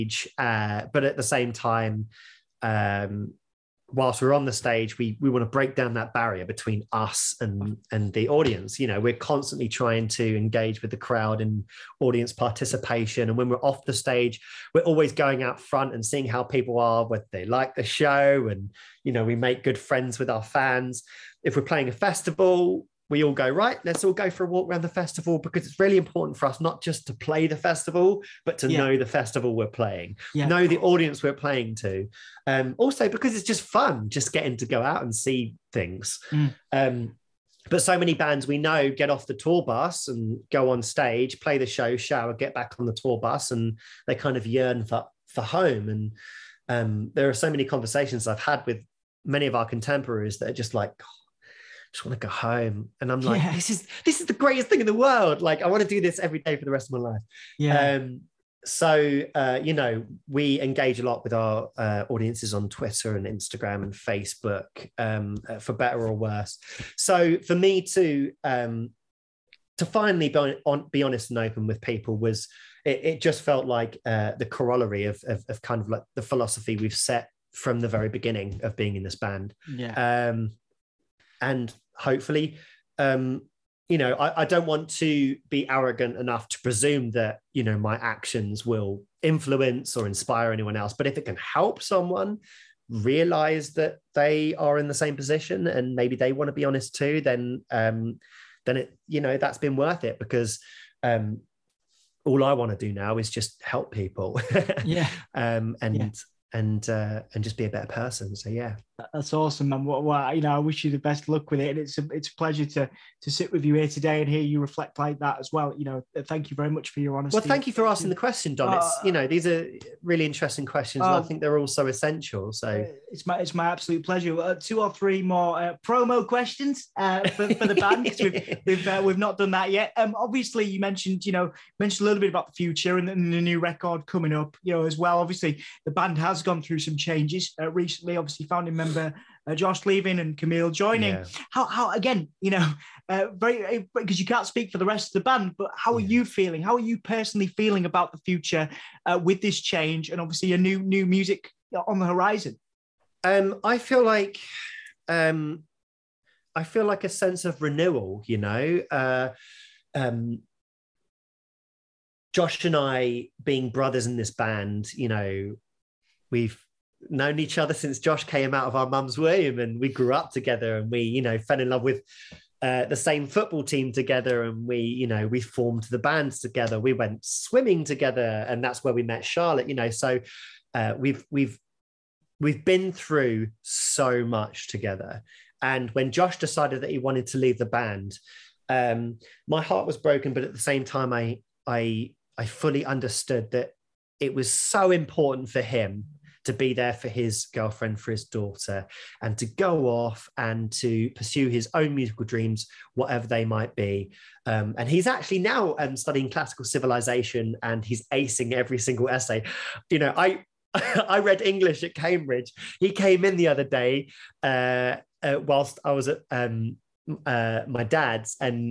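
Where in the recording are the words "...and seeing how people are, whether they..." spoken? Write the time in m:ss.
0:15.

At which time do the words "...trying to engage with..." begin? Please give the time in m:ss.
0:09.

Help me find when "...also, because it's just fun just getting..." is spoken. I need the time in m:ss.
0:32.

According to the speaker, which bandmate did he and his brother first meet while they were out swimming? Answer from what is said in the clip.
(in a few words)
Charlotte.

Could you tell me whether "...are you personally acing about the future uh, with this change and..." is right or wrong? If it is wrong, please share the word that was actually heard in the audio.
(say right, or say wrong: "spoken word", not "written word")
wrong: "feeling", not "acing".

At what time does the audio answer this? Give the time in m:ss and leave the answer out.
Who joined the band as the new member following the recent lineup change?
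2:20.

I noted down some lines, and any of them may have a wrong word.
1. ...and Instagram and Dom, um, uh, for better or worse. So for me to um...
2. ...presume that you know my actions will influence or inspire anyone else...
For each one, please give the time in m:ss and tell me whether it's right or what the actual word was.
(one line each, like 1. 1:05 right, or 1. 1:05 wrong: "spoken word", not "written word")
1. 1:03 wrong: "Facebook", not "Dom"
2. 1:26 right.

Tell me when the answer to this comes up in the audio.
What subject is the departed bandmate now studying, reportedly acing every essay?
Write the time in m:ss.
3:26.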